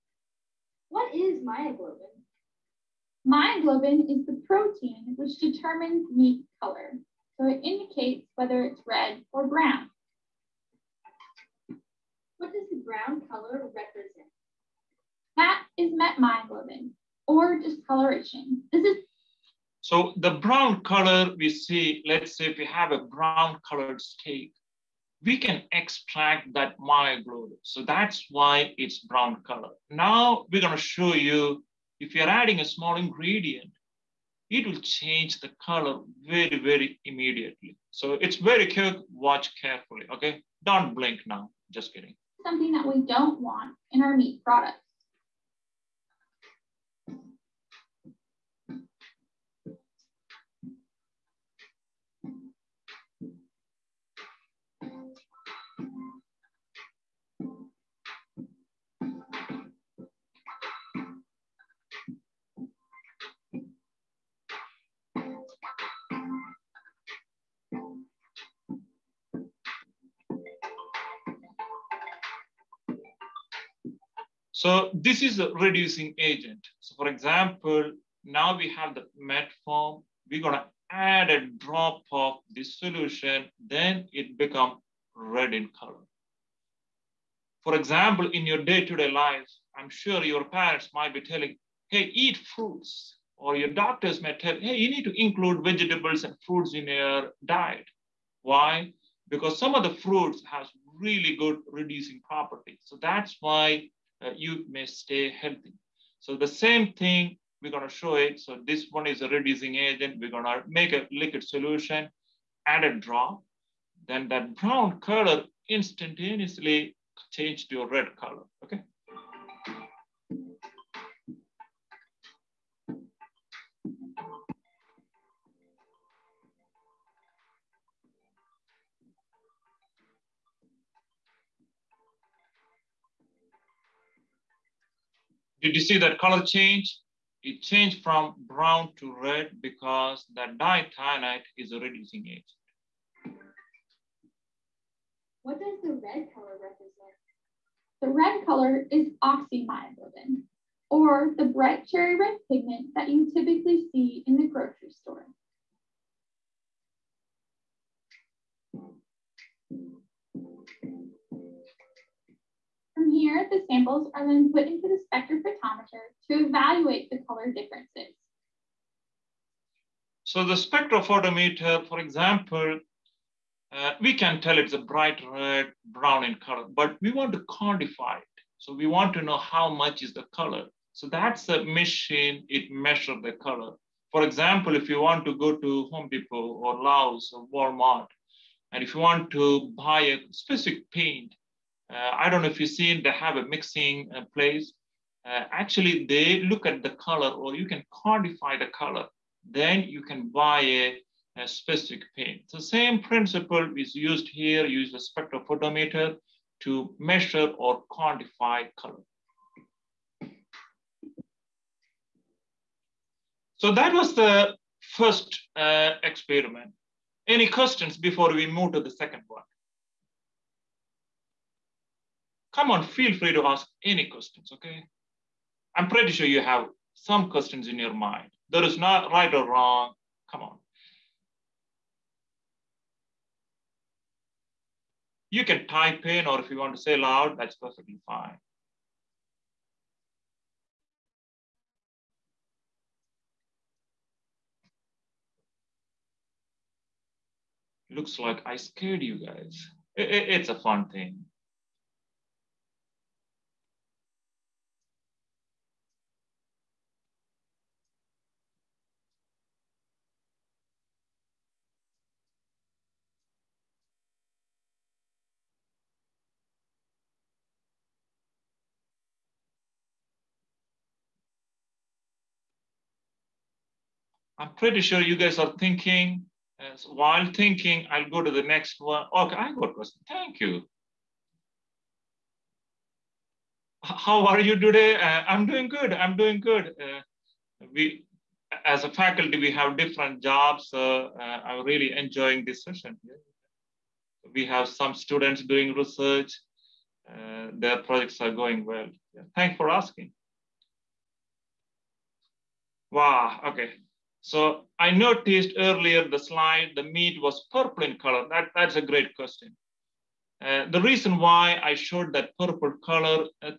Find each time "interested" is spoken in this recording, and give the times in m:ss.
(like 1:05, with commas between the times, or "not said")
not said.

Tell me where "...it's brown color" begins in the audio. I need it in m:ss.
0:28.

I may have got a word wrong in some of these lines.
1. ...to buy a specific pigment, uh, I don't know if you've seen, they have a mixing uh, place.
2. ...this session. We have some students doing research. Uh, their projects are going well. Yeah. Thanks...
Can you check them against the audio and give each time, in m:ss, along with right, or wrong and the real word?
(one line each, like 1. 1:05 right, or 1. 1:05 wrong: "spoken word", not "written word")
1. 3:09 wrong: "paint", not "pigment"
2. 4:52 right.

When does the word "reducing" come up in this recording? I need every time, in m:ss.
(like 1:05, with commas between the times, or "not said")
1:15, 1:41, 1:49, 2:21.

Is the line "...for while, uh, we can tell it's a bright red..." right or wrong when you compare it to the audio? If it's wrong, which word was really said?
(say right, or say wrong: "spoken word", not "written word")
wrong: "example", not "while".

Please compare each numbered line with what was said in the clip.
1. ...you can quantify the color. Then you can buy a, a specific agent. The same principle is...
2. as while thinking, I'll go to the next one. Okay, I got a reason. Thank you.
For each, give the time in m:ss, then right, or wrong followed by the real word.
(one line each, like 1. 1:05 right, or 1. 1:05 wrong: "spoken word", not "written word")
1. 3:17 wrong: "paint", not "agent"
2. 4:36 wrong: "question", not "reason".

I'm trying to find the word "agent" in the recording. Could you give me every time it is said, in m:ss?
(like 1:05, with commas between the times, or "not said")
1:16, 1:49, 2:22.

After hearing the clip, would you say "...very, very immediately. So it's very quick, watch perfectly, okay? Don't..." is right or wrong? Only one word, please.
wrong.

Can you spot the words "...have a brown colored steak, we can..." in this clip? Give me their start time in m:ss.
0:22.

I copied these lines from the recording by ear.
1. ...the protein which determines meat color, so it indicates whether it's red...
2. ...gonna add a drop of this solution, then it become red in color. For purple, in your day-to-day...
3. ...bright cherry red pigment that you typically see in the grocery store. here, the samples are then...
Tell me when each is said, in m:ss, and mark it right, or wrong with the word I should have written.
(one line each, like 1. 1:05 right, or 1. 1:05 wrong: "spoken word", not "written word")
1. 0:04 right
2. 1:20 wrong: "example", not "purple"
3. 2:31 right.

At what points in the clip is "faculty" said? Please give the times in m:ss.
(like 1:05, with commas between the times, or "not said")
4:49.